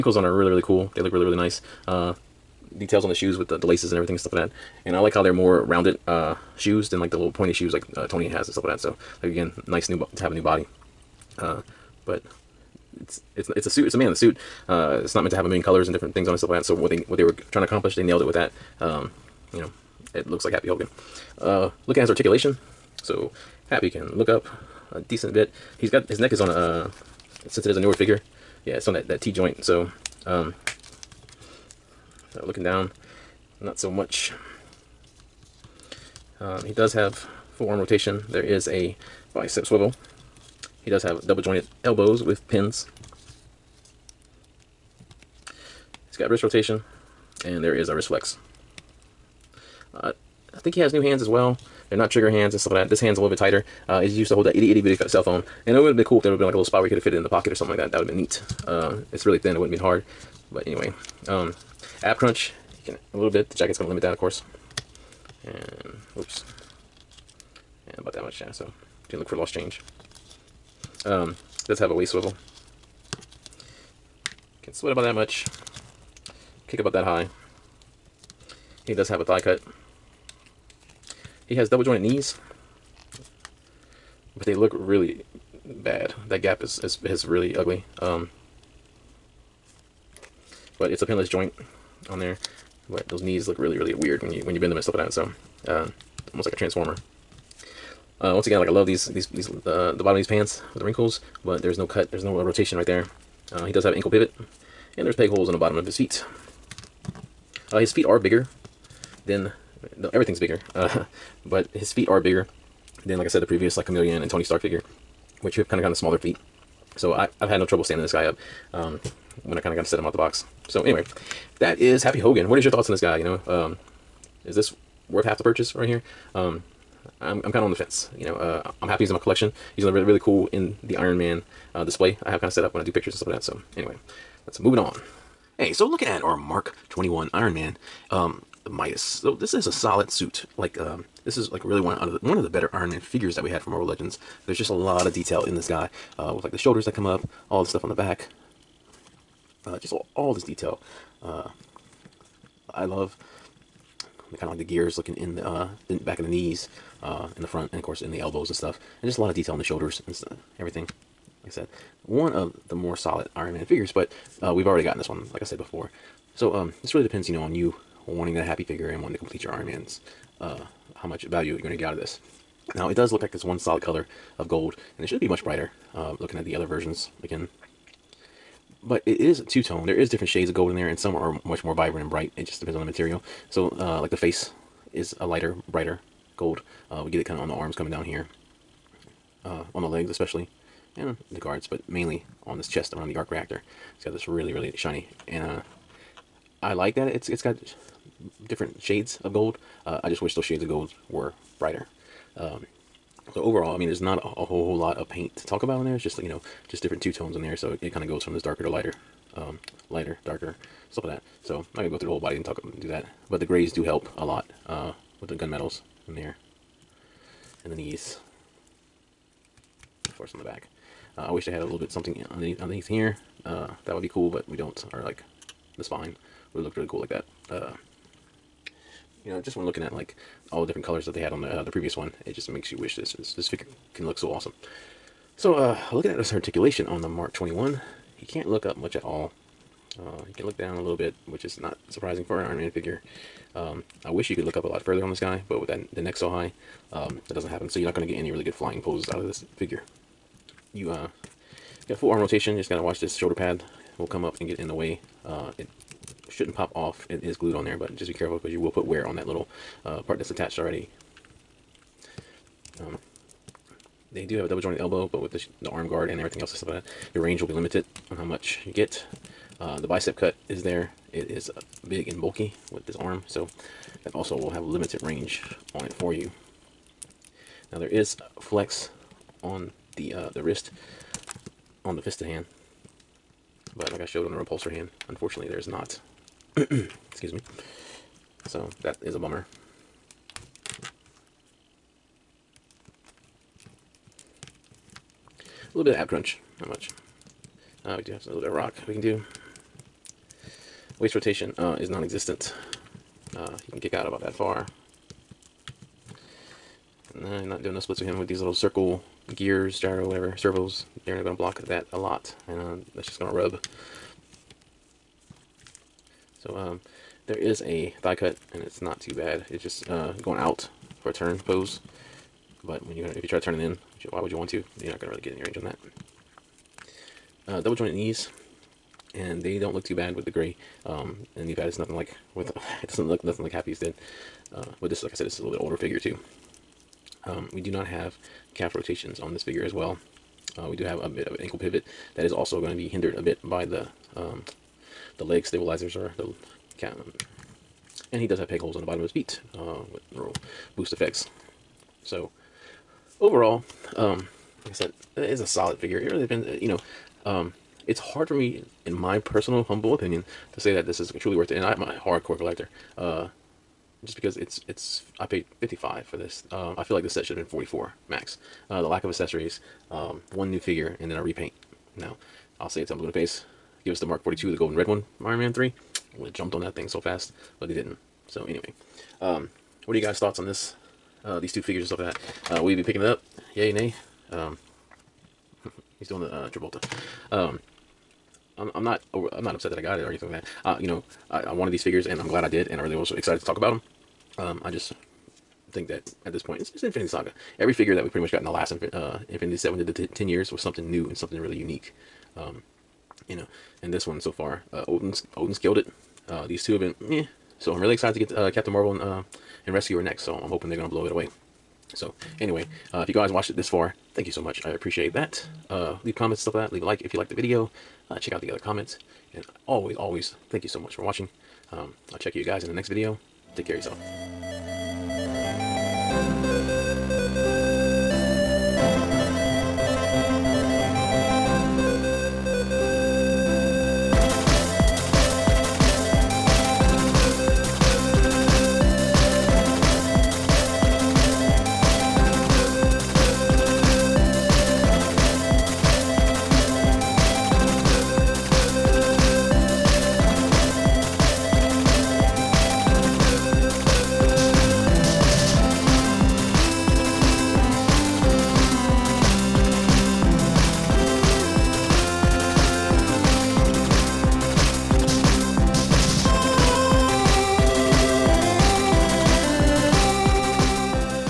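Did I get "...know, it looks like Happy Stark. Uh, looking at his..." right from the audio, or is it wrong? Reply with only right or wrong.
wrong.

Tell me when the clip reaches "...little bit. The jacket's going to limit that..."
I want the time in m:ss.
1:03.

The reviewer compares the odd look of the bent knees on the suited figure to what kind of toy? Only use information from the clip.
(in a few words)
a transformer.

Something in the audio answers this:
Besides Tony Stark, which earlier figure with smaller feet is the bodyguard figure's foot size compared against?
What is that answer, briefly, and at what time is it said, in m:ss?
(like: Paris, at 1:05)
Chameleon, at 1:53.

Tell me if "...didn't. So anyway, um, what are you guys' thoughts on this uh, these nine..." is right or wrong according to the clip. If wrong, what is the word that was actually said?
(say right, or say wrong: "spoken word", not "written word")
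wrong: "two", not "nine".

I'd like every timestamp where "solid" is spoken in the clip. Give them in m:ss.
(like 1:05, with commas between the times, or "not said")
2:19, 2:42, 2:53, 5:55.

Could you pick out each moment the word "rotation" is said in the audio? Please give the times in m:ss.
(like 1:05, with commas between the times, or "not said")
0:37, 0:46, 1:42, 4:12, 5:01, 5:38.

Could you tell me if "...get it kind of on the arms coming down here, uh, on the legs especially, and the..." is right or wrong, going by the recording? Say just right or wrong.
right.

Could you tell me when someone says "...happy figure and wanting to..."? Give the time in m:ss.
2:48.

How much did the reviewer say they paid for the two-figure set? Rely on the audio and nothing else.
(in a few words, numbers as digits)
55.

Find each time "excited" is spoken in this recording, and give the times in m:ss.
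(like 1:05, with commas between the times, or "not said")
6:33, 6:47.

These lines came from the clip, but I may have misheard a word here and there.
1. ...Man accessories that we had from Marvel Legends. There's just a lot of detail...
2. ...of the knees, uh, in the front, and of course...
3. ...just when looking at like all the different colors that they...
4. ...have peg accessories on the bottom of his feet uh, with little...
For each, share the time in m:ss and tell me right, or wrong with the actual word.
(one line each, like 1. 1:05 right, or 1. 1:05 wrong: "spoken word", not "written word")
1. 2:22 wrong: "figures", not "accessories"
2. 2:36 right
3. 3:49 right
4. 5:48 wrong: "holes", not "accessories".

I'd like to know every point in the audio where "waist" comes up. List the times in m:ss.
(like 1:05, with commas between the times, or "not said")
1:11, 5:00.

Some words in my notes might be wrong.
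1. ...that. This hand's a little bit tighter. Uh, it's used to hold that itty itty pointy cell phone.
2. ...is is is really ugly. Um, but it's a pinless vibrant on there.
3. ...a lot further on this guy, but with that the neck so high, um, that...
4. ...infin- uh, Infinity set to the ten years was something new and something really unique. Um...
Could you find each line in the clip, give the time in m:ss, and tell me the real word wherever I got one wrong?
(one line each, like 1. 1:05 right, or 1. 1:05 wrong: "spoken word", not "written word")
1. 0:52 wrong: "bitty", not "pointy"
2. 1:26 wrong: "joint", not "vibrant"
3. 4:04 right
4. 6:38 right.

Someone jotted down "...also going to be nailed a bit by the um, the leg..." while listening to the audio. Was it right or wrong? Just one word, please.
wrong.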